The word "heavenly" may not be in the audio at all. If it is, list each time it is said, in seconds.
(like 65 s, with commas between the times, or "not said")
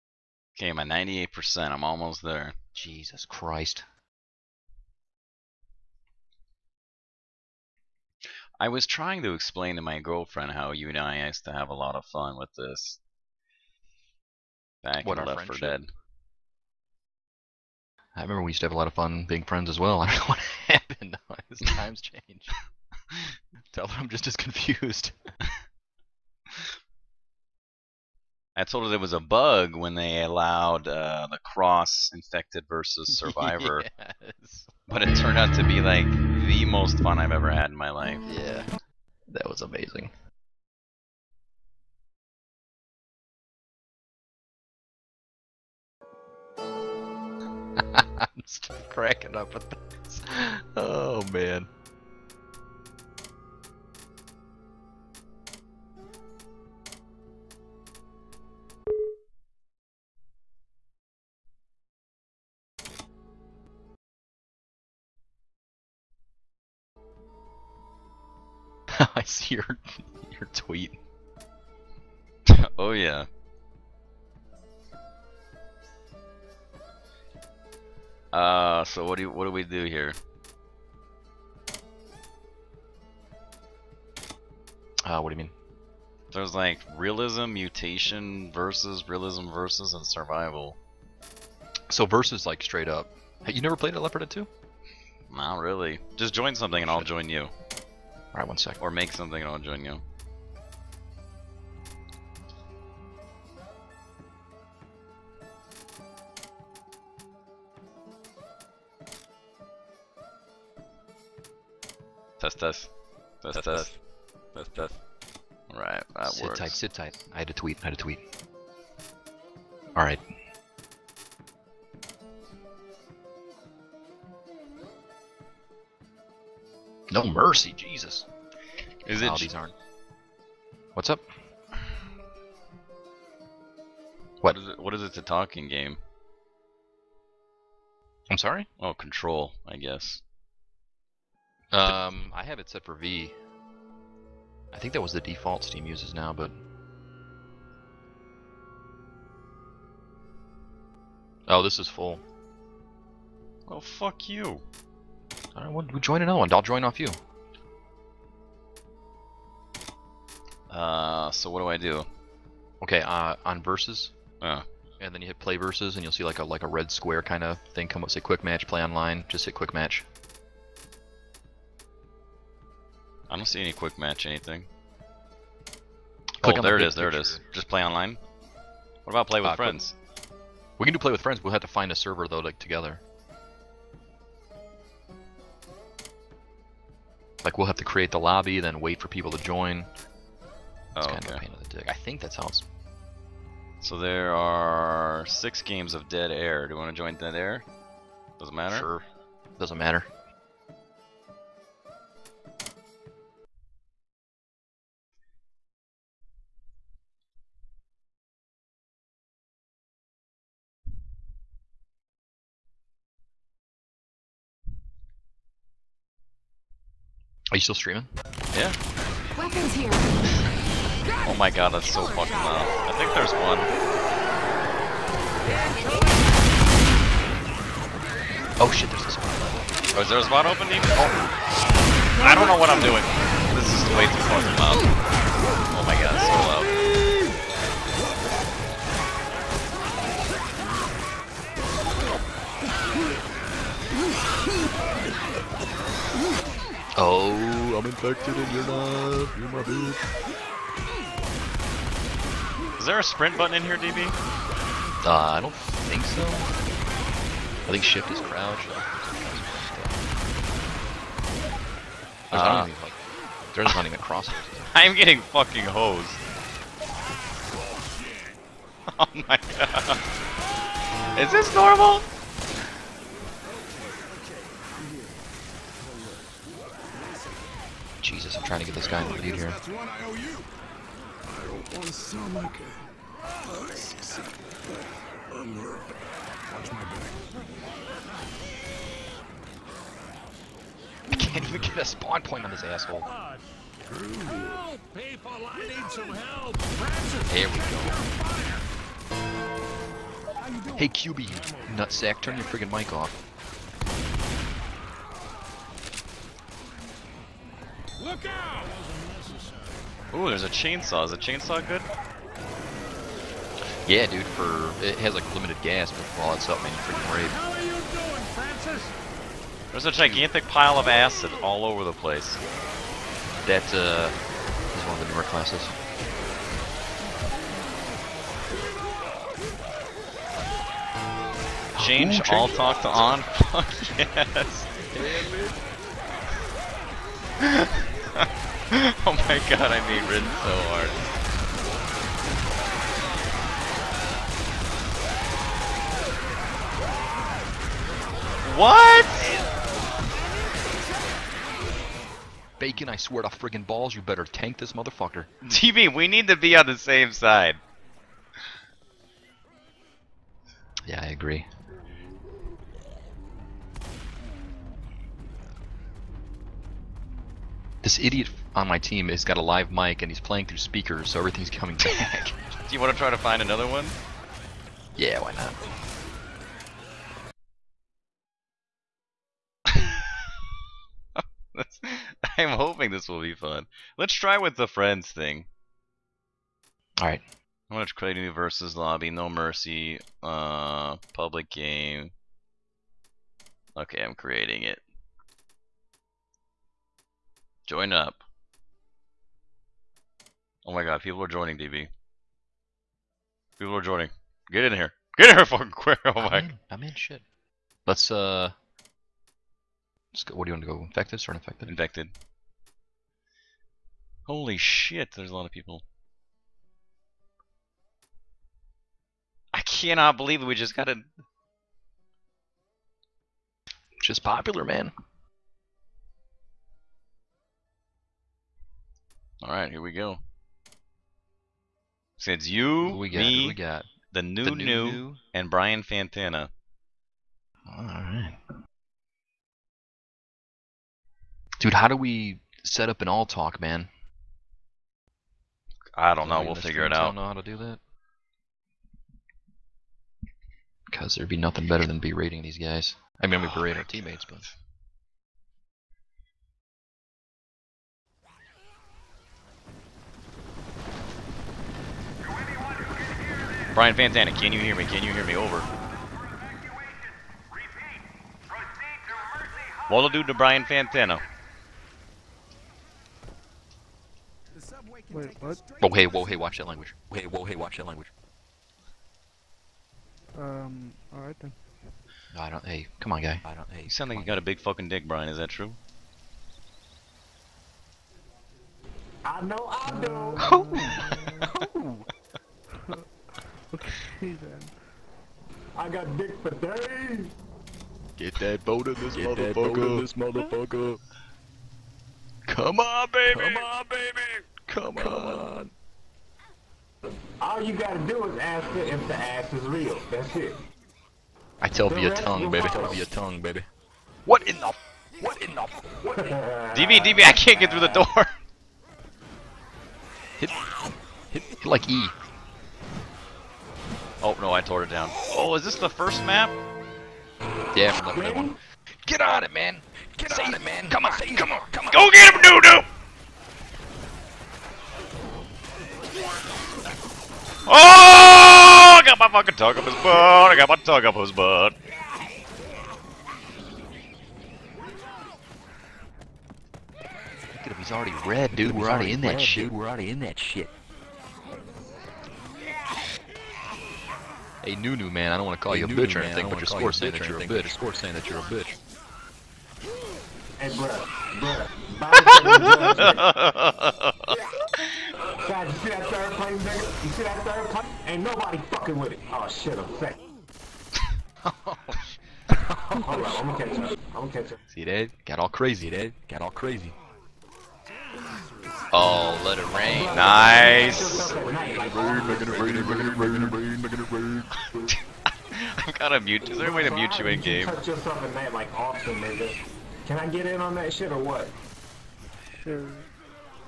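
not said.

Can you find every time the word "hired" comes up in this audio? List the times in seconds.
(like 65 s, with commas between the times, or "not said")
not said.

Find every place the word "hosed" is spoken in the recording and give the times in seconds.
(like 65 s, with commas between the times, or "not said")
265 s.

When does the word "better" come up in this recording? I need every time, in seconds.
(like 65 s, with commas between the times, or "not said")
354 s, 451 s.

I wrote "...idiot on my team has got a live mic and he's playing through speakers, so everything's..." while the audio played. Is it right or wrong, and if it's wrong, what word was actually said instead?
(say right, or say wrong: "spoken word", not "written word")
right.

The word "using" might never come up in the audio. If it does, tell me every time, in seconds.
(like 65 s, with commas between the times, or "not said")
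not said.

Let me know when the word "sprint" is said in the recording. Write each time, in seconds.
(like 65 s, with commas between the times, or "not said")
253 s.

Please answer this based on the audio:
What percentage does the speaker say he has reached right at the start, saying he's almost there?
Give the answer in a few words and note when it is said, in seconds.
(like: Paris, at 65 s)
98%, at 0 s.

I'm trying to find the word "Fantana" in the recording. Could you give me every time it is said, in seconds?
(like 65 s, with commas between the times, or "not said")
435 s, 463 s, 470 s.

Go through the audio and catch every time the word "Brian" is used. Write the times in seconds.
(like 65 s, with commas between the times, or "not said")
435 s, 463 s, 470 s, 485 s.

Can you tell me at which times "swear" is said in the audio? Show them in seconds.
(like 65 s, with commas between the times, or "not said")
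352 s.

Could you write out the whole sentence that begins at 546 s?
Look at him, he's already red, dude.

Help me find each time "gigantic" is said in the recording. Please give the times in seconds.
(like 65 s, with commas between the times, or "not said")
319 s.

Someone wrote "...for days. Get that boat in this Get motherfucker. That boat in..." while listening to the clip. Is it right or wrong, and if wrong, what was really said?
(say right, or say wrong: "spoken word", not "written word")
right.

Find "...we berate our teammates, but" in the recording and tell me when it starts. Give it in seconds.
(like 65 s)
453 s.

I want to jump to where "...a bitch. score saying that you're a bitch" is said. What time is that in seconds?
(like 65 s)
557 s.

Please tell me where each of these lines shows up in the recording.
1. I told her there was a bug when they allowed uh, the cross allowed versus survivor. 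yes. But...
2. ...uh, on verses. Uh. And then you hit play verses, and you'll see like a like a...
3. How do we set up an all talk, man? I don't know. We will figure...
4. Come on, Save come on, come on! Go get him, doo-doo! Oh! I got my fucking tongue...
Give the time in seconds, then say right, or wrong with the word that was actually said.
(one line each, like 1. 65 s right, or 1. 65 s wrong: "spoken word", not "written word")
1. 28 s wrong: "infected", not "allowed"
2. 163 s right
3. 441 s right
4. 530 s right.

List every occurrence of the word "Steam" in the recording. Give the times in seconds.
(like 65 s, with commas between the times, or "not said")
145 s.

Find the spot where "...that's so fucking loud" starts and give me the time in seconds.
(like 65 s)
221 s.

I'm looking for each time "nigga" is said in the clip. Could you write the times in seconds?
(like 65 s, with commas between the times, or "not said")
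566 s, 589 s.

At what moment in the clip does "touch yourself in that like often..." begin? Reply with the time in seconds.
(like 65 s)
587 s.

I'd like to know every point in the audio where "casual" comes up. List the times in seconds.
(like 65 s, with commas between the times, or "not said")
not said.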